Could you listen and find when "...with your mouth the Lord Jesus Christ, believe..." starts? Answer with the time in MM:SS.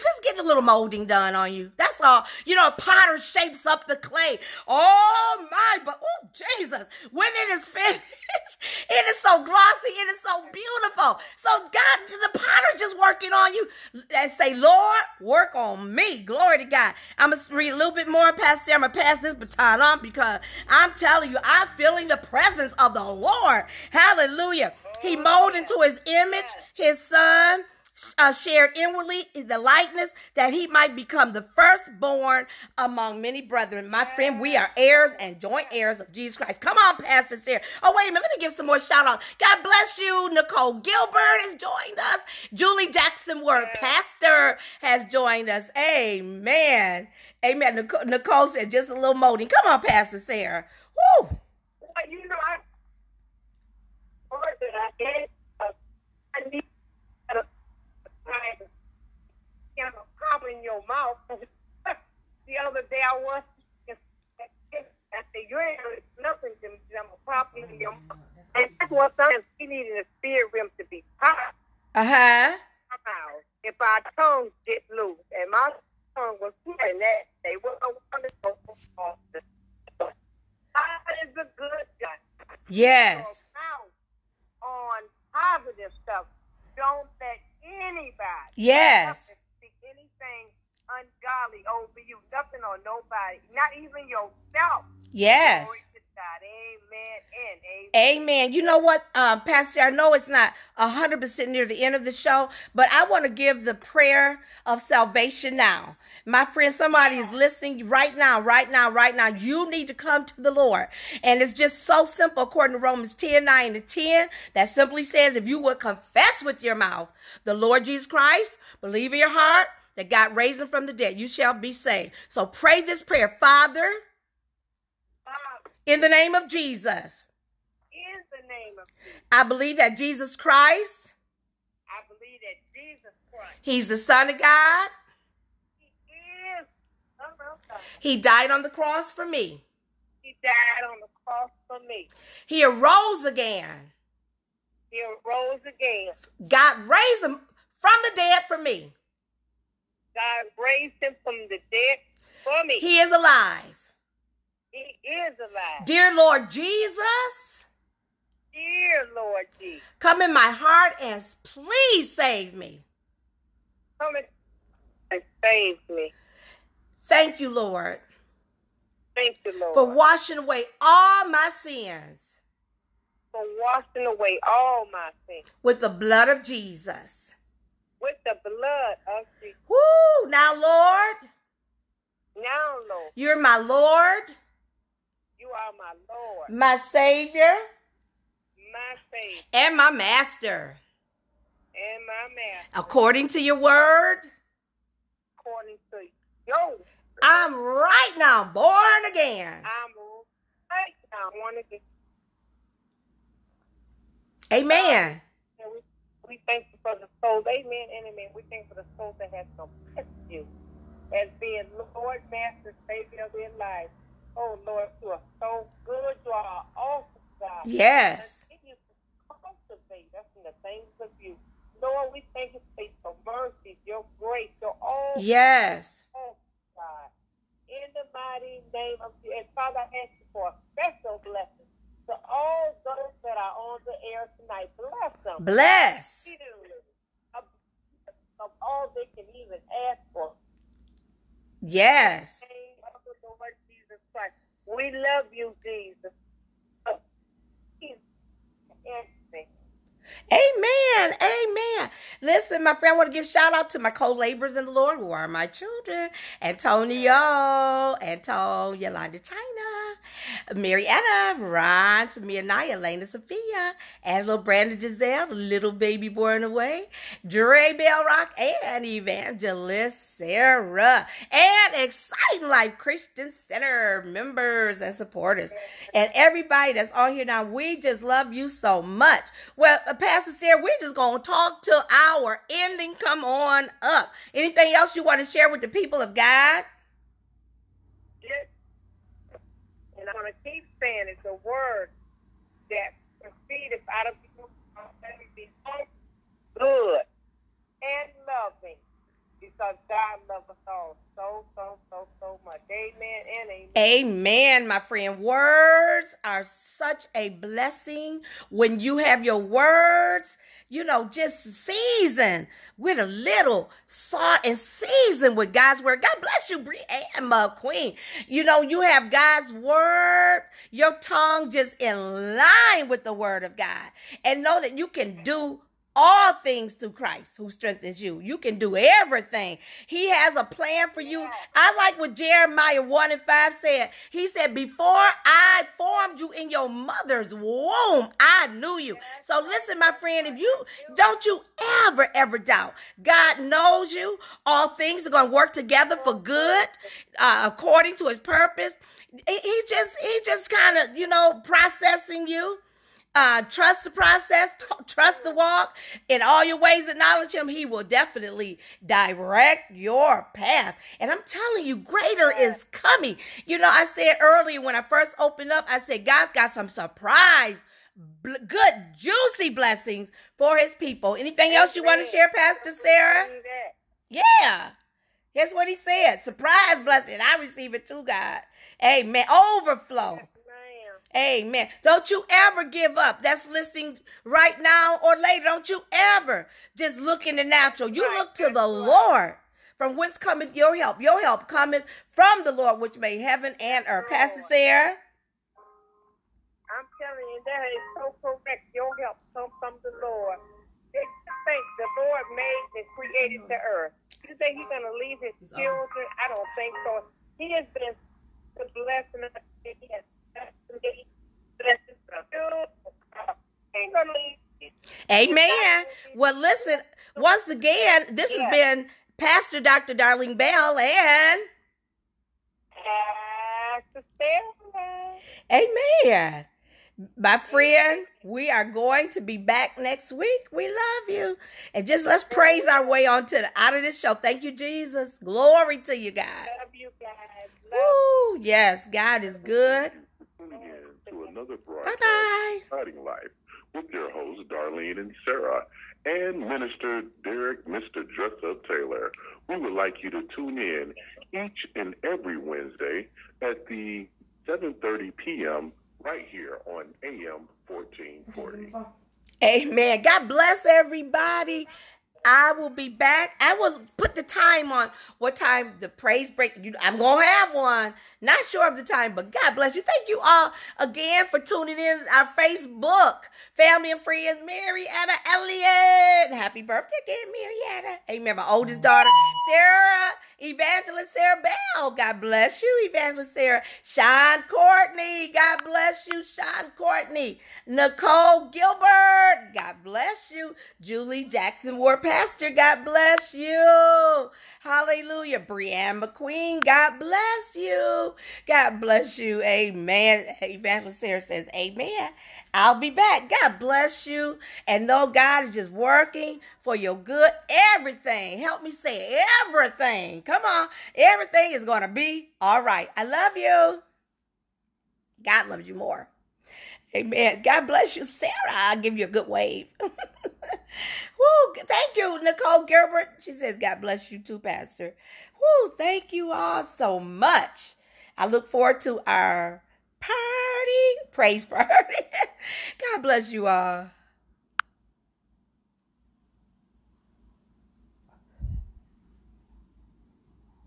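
01:56.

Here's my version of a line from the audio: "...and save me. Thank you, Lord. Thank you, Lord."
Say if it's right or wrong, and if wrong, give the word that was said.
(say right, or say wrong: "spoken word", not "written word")
right.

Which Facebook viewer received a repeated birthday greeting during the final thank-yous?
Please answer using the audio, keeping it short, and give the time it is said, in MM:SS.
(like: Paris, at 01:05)
Marietta Elliott, at 07:54.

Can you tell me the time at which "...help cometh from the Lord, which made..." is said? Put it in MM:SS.
06:31.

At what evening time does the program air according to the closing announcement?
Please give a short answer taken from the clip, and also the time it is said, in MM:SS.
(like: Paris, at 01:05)
7:30 p.m., at 07:34.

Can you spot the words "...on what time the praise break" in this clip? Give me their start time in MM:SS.
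07:44.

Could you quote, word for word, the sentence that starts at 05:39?
So listen, my friend, if you don't you ever, ever doubt God knows you.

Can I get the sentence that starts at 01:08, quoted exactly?
And needed a rim to be Uh-huh.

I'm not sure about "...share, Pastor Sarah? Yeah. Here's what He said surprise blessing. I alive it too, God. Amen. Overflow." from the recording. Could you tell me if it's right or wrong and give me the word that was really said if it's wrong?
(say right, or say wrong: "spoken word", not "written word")
wrong: "receive", not "alive".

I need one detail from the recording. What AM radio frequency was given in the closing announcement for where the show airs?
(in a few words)
1440.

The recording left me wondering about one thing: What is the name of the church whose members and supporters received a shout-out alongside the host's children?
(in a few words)
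Exciting Life Christian Center.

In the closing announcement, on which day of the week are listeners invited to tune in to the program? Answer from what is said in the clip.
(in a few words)
Wednesday.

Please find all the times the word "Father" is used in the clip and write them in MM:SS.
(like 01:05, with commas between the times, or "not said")
02:03, 03:49.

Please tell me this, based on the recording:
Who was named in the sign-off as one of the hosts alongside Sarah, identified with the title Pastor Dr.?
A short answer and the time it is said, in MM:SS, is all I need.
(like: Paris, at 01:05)
Darlene Bell, at 06:59.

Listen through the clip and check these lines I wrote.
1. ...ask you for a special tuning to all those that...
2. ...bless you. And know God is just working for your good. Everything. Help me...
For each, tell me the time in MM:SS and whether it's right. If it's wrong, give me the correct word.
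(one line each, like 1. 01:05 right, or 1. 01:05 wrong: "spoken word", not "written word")
1. 03:50 wrong: "blessing", not "tuning"
2. 08:23 right.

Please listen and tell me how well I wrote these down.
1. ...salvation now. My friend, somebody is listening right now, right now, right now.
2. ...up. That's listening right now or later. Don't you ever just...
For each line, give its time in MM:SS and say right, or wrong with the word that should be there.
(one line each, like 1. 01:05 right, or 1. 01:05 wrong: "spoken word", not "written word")
1. 01:44 right
2. 06:22 right.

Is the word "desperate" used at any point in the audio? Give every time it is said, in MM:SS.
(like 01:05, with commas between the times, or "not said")
not said.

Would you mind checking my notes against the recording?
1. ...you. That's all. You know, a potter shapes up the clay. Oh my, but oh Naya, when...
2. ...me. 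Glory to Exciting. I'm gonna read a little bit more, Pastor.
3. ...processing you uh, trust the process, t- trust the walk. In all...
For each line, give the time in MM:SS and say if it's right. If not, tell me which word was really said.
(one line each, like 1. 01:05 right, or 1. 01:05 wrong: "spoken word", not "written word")
1. 00:01 wrong: "Jesus", not "Naya"
2. 00:15 wrong: "God", not "Exciting"
3. 05:51 right.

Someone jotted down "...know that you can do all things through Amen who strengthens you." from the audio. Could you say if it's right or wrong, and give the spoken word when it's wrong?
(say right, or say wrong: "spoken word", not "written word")
wrong: "Christ", not "Amen".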